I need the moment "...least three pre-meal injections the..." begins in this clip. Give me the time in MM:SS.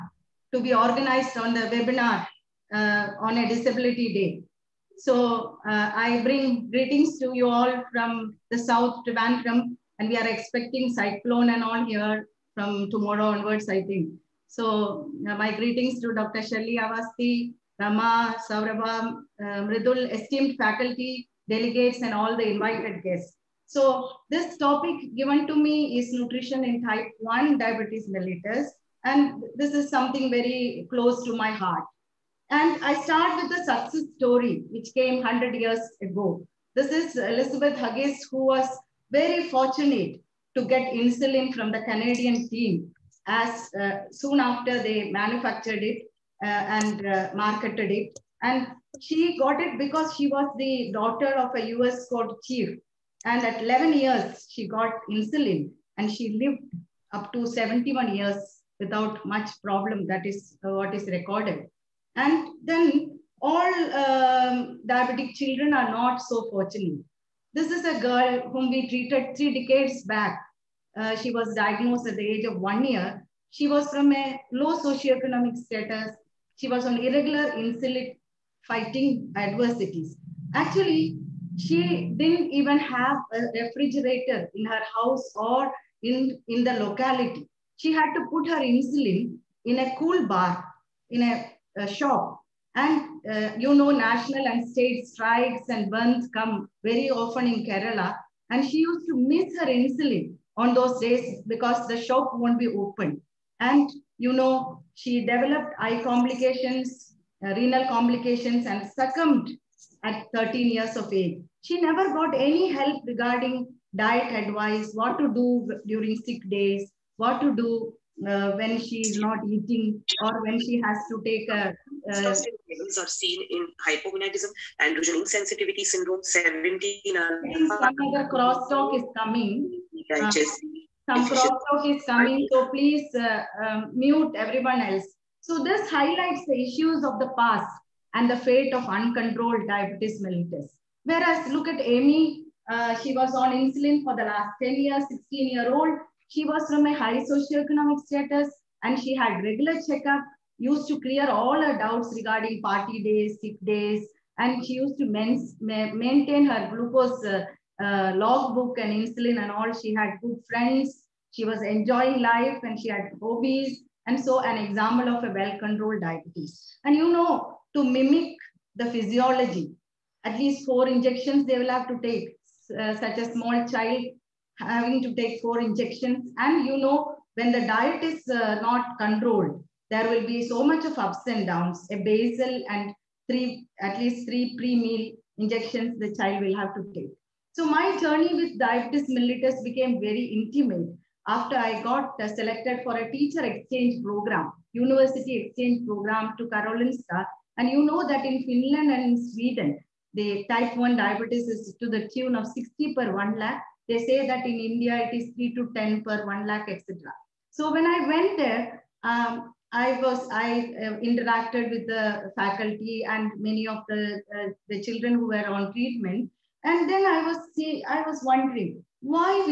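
03:03.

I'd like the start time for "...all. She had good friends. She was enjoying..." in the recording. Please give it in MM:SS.
02:39.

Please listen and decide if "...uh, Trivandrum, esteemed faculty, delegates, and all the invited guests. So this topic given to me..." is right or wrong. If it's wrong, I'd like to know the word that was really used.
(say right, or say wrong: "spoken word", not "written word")
wrong: "Mridul", not "Trivandrum".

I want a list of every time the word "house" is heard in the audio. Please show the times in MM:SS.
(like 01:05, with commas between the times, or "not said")
01:24.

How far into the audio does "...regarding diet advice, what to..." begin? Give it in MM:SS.
01:53.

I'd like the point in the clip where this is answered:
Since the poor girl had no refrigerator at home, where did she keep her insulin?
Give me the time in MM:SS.
01:29.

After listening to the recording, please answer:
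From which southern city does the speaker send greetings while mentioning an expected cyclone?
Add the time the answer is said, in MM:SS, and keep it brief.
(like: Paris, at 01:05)
Trivandrum, at 00:09.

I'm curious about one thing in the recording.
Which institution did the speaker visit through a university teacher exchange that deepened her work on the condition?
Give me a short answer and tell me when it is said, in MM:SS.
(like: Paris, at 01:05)
Karolinska, at 03:16.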